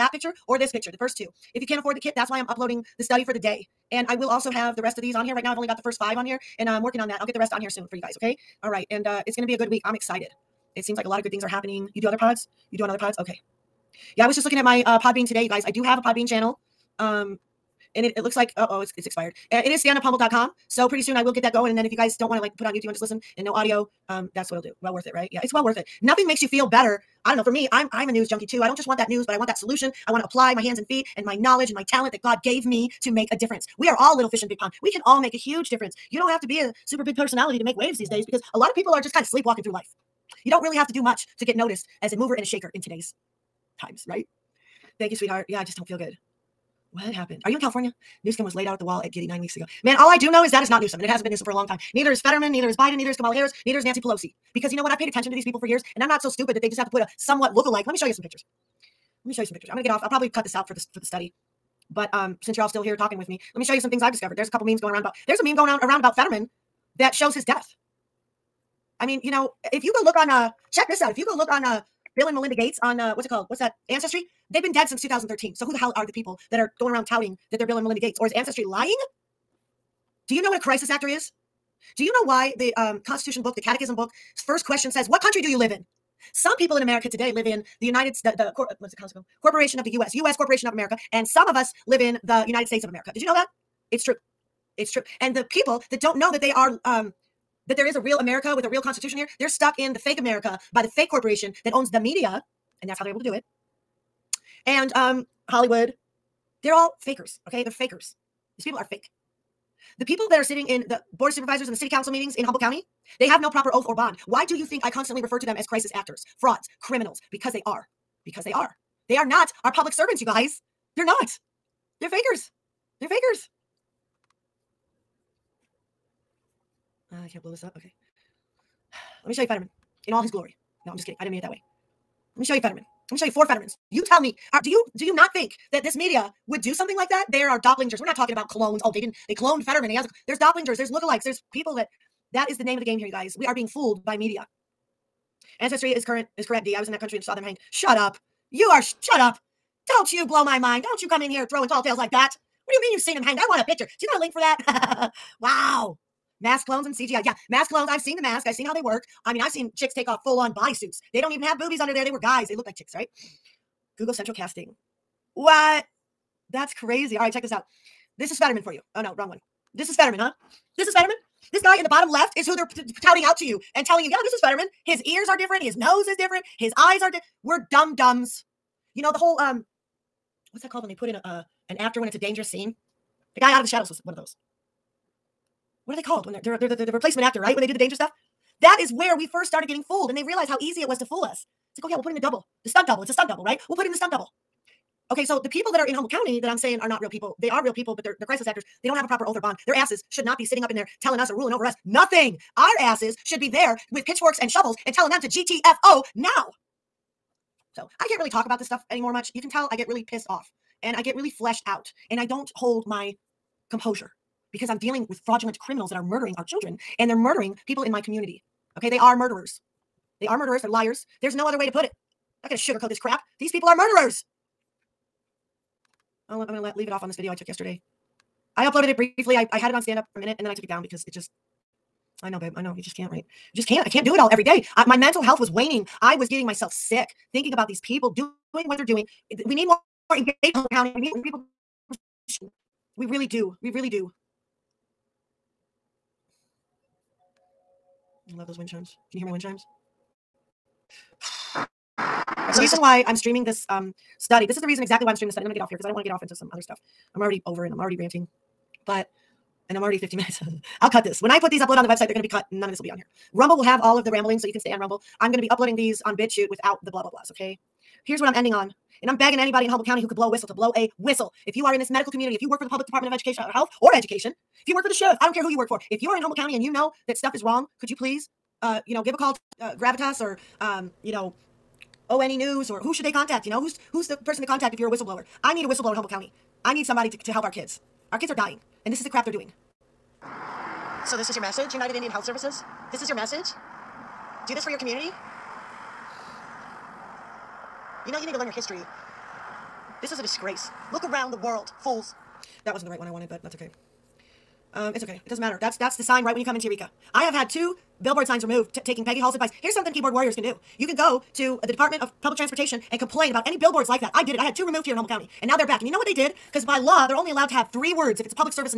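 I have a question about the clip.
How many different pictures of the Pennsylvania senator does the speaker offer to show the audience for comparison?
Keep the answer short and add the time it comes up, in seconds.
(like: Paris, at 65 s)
4, at 133 s.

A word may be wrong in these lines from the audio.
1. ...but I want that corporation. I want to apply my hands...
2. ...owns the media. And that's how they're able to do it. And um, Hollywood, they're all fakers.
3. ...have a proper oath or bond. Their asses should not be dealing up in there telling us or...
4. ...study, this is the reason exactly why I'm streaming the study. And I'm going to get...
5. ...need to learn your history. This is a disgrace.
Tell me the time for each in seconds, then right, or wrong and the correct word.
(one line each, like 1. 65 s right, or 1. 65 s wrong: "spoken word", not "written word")
1. 29 s wrong: "solution", not "corporation"
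2. 101 s right
3. 198 s wrong: "sitting", not "dealing"
4. 254 s right
5. 298 s right.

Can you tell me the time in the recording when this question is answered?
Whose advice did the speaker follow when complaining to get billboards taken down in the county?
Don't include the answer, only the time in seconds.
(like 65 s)
309 s.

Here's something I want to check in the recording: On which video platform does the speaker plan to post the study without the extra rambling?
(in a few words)
BitChute.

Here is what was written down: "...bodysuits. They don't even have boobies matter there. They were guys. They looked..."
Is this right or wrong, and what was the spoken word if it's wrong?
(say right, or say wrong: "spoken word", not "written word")
wrong: "under", not "matter".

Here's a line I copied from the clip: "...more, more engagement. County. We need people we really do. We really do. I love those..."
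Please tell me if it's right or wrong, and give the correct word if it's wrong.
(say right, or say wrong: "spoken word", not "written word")
right.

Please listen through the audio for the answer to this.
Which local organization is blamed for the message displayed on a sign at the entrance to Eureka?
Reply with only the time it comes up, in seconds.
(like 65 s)
291 s.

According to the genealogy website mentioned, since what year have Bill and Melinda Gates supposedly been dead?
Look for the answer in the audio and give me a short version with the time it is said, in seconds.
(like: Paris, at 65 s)
2013, at 75 s.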